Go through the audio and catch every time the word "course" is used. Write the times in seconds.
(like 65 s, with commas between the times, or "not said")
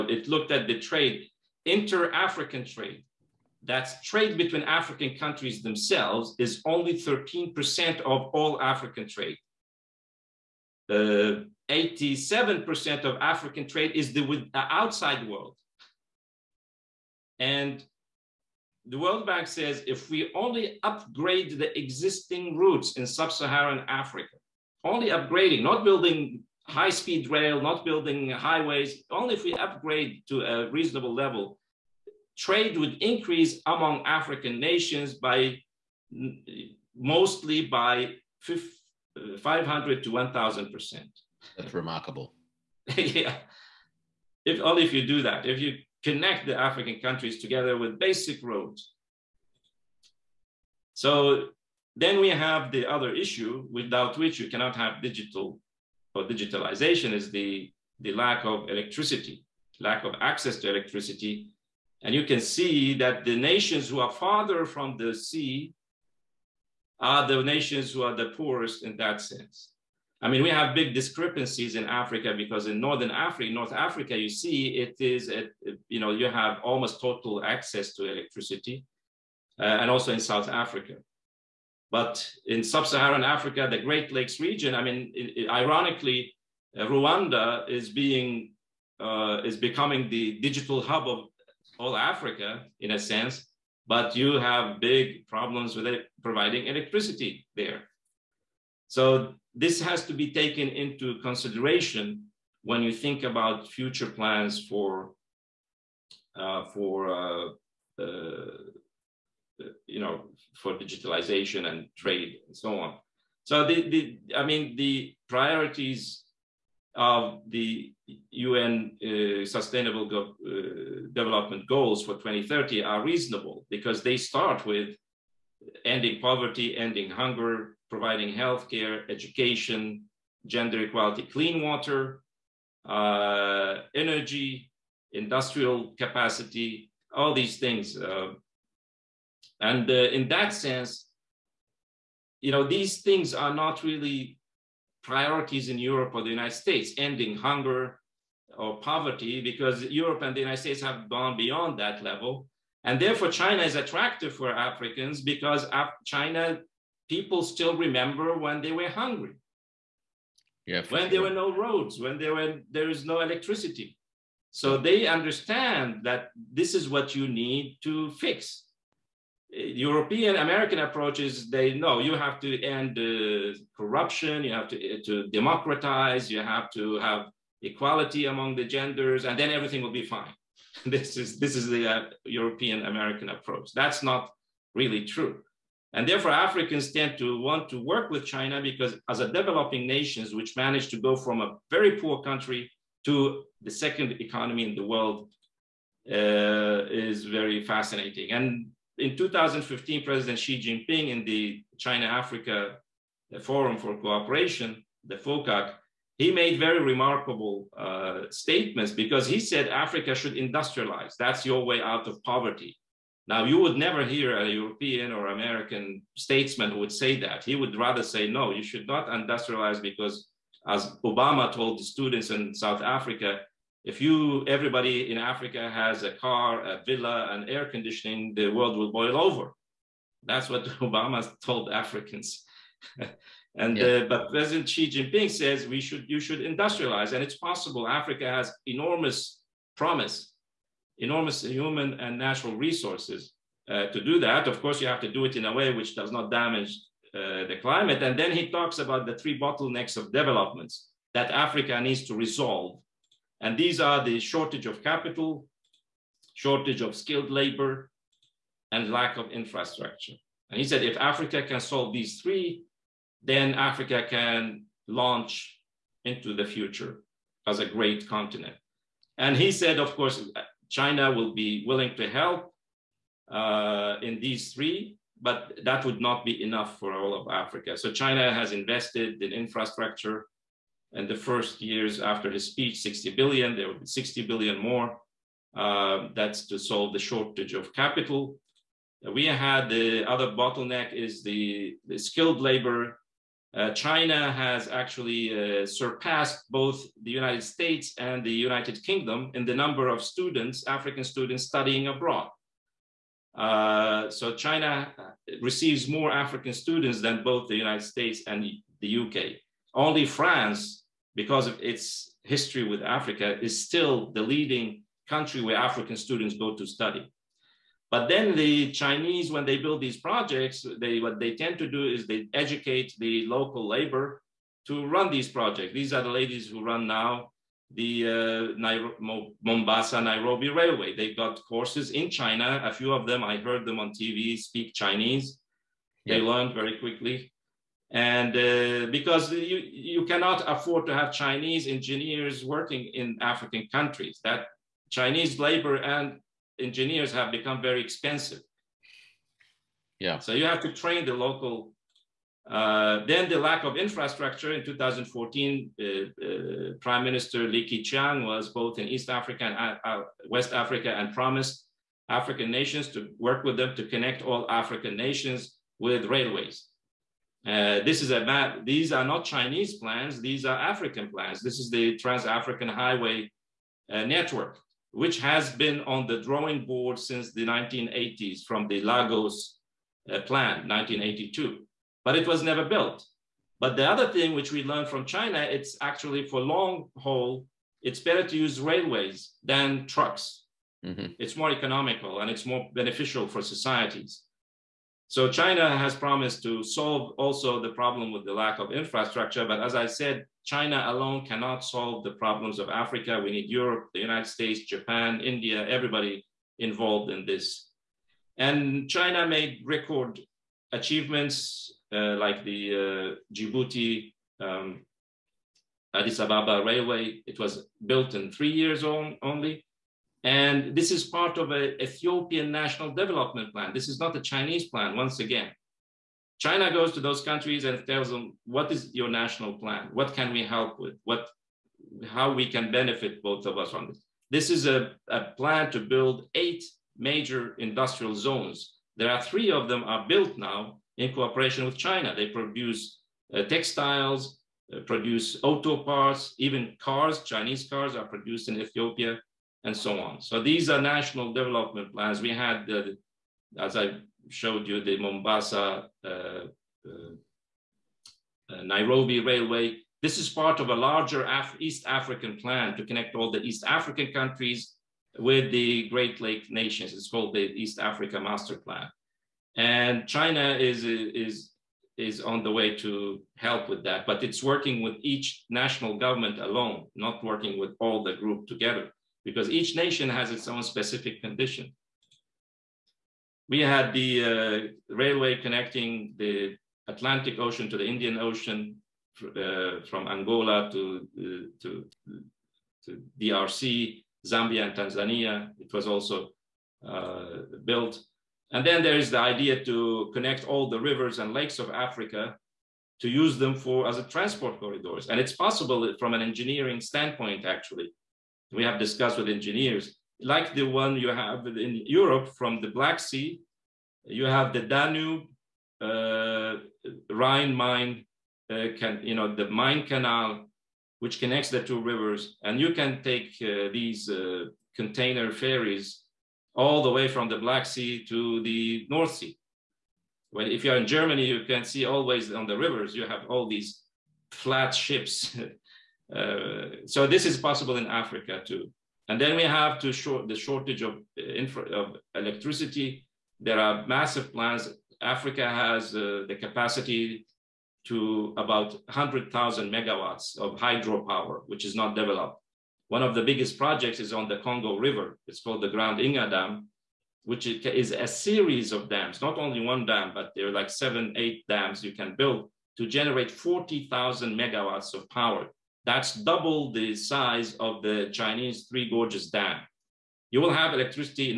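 244 s, 269 s, 331 s.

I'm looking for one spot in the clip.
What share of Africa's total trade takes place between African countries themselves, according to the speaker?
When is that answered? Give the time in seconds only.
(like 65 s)
6 s.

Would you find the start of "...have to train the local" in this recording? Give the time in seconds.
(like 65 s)
350 s.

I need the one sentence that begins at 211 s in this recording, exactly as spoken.
That's your way out of poverty.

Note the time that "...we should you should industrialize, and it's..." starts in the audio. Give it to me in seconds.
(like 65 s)
235 s.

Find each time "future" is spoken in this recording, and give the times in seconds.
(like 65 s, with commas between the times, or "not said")
103 s, 266 s.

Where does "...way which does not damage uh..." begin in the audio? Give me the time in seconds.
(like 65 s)
245 s.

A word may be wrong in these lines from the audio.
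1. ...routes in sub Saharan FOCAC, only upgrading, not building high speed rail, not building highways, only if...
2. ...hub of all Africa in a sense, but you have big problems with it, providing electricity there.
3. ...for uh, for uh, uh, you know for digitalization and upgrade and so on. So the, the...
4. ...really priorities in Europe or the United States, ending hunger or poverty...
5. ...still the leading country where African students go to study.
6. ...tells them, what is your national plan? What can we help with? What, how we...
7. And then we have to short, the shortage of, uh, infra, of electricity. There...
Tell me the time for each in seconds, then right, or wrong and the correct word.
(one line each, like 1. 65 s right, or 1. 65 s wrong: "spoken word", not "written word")
1. 22 s wrong: "Africa", not "FOCAC"
2. 90 s right
3. 104 s wrong: "trade", not "upgrade"
4. 143 s right
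5. 313 s right
6. 427 s right
7. 539 s right.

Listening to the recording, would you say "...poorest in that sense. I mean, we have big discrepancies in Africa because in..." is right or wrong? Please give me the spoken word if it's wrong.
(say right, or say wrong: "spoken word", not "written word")
right.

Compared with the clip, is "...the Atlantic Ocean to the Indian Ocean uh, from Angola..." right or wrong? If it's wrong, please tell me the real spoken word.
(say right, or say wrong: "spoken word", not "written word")
right.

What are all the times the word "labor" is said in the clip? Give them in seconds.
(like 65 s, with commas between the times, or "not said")
257 s, 292 s, 323 s, 345 s.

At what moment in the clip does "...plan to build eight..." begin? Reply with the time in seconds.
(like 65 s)
435 s.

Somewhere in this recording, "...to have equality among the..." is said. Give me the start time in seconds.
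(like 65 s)
176 s.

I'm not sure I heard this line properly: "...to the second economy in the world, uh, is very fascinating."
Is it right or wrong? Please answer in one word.
right.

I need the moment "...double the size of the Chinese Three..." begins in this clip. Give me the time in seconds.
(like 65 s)
566 s.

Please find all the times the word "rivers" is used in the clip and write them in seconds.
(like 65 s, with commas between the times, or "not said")
500 s, 521 s, 532 s, 554 s.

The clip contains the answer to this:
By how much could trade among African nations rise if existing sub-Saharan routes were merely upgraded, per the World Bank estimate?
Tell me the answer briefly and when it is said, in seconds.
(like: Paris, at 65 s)
500 to 1,000%, at 39 s.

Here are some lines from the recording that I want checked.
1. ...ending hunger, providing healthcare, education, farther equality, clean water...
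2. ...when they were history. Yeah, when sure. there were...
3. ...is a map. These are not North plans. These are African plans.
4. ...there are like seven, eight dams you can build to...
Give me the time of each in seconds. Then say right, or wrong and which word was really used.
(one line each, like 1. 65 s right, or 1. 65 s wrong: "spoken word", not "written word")
1. 126 s wrong: "gender", not "farther"
2. 158 s wrong: "hungry", not "history"
3. 368 s wrong: "Chinese", not "North"
4. 560 s right.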